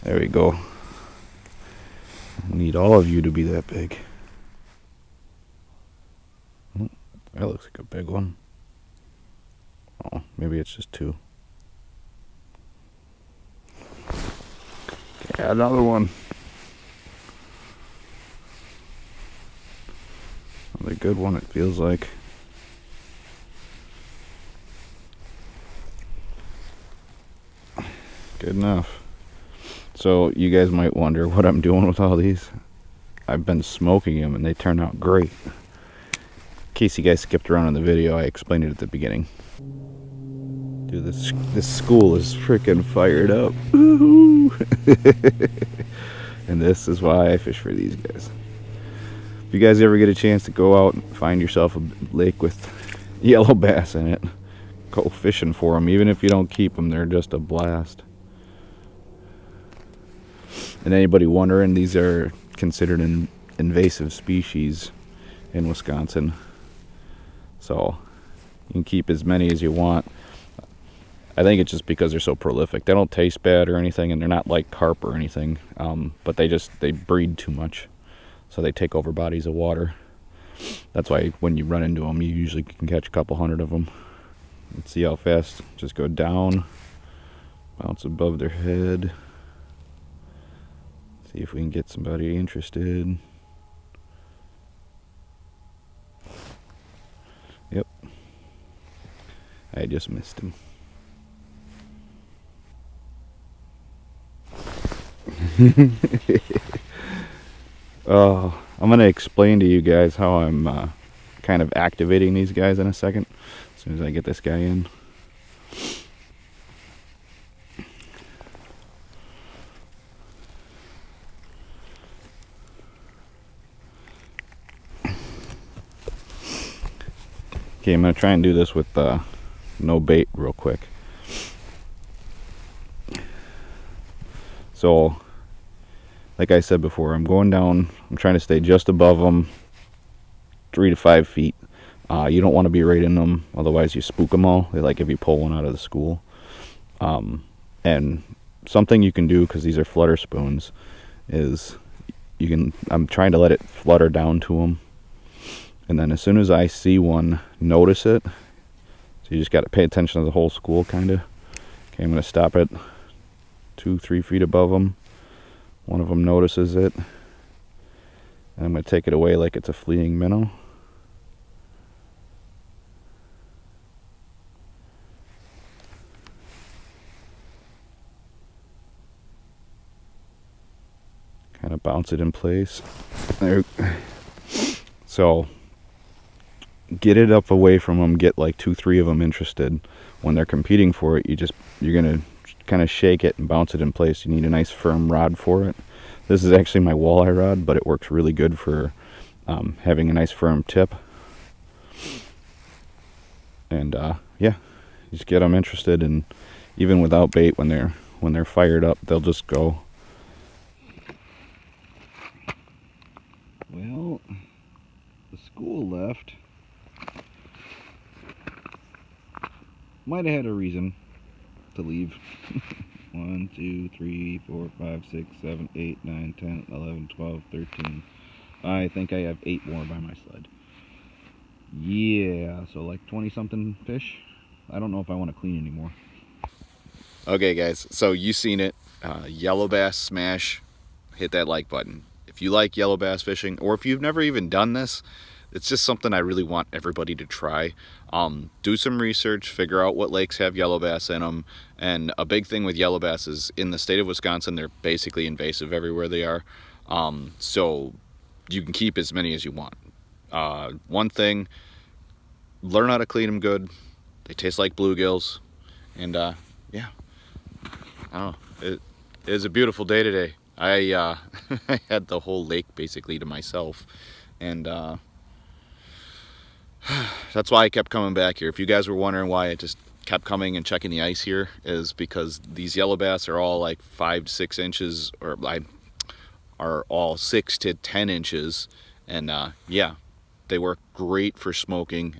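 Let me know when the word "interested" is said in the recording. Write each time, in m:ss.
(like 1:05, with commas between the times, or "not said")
1:32, 3:09, 3:25.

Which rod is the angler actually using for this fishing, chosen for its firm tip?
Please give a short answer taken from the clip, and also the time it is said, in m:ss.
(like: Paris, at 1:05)
walleye rod, at 3:16.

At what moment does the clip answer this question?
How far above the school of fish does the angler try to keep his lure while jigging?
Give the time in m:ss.
2:20.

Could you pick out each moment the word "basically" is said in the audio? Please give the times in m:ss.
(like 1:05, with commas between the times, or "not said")
4:14, 4:32.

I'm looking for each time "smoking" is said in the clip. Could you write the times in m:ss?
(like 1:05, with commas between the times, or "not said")
0:33, 4:51.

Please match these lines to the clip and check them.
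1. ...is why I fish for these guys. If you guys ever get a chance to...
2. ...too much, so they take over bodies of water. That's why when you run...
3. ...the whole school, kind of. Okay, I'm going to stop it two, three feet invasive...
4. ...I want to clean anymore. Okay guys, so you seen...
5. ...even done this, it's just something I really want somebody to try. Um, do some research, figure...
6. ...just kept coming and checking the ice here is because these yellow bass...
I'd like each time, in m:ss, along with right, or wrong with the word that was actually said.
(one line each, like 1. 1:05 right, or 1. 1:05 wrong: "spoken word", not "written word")
1. 0:46 right
2. 1:17 right
3. 2:40 wrong: "above", not "invasive"
4. 3:55 right
5. 4:04 wrong: "everybody", not "somebody"
6. 4:39 right.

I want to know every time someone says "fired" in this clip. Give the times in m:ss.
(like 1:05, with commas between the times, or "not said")
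0:42, 3:28.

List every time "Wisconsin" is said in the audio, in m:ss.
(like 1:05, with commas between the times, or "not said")
1:05, 4:14.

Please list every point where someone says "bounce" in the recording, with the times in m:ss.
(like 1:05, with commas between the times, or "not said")
1:27, 3:01, 3:13.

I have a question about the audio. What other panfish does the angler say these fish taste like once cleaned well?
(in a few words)
bluegills.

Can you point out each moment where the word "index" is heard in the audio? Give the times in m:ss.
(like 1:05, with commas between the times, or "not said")
not said.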